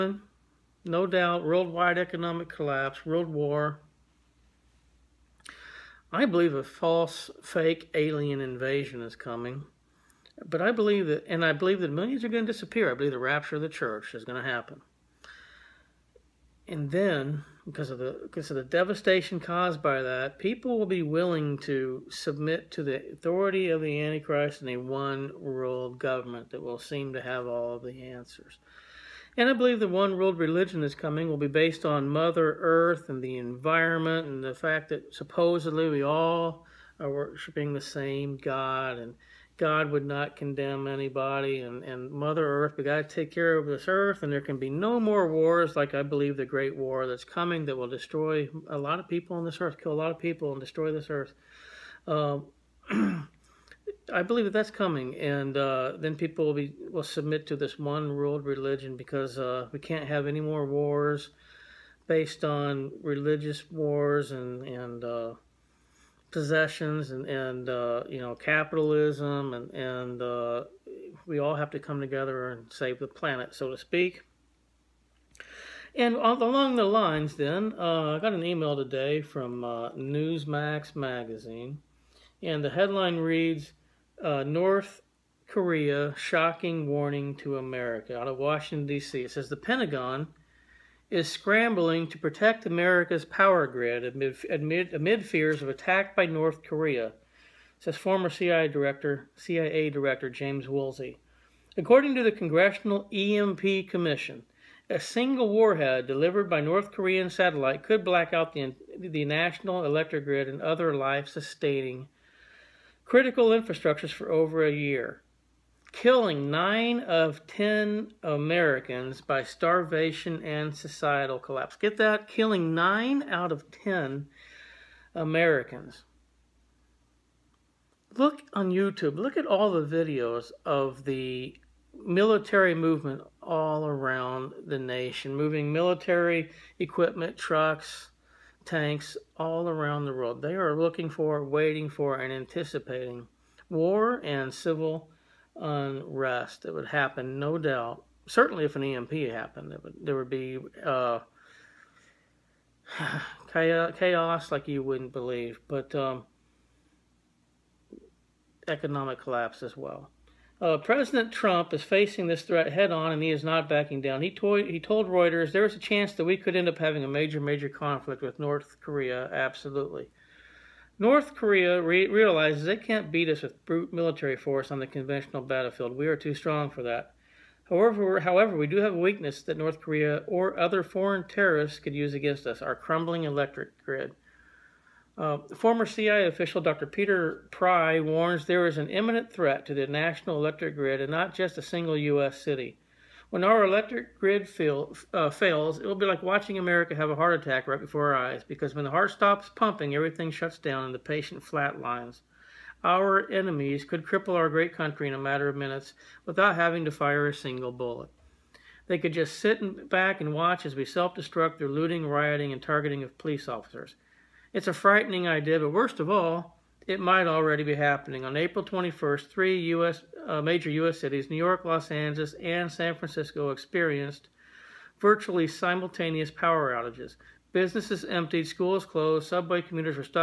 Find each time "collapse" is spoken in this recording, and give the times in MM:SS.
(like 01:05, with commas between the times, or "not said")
00:02, 02:01, 02:39.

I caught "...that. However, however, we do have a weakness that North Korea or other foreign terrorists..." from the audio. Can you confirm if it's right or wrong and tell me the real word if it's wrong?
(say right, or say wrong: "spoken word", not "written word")
right.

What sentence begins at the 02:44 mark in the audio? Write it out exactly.
He, told, he told Reuters there is a chance that we could end up having a major, major conflict with North Korea.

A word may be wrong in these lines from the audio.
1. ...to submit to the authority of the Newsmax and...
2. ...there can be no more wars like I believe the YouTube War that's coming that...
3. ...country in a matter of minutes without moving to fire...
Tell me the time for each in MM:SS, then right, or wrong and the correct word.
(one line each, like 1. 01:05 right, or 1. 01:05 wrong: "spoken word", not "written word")
1. 00:21 wrong: "Antichrist", not "Newsmax"
2. 00:44 wrong: "Great", not "YouTube"
3. 03:24 wrong: "having", not "moving".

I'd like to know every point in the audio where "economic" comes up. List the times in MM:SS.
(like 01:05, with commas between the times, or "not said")
00:01, 02:38.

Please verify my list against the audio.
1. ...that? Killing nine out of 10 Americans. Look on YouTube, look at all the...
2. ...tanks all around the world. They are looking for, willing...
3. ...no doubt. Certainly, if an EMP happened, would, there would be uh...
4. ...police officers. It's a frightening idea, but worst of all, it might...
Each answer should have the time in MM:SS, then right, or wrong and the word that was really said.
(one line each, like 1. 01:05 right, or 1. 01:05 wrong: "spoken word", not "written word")
1. 02:01 right
2. 02:18 wrong: "waiting", not "willing"
3. 02:27 right
4. 03:33 right.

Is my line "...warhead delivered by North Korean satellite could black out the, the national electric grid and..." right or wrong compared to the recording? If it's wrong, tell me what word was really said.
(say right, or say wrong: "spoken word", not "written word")
right.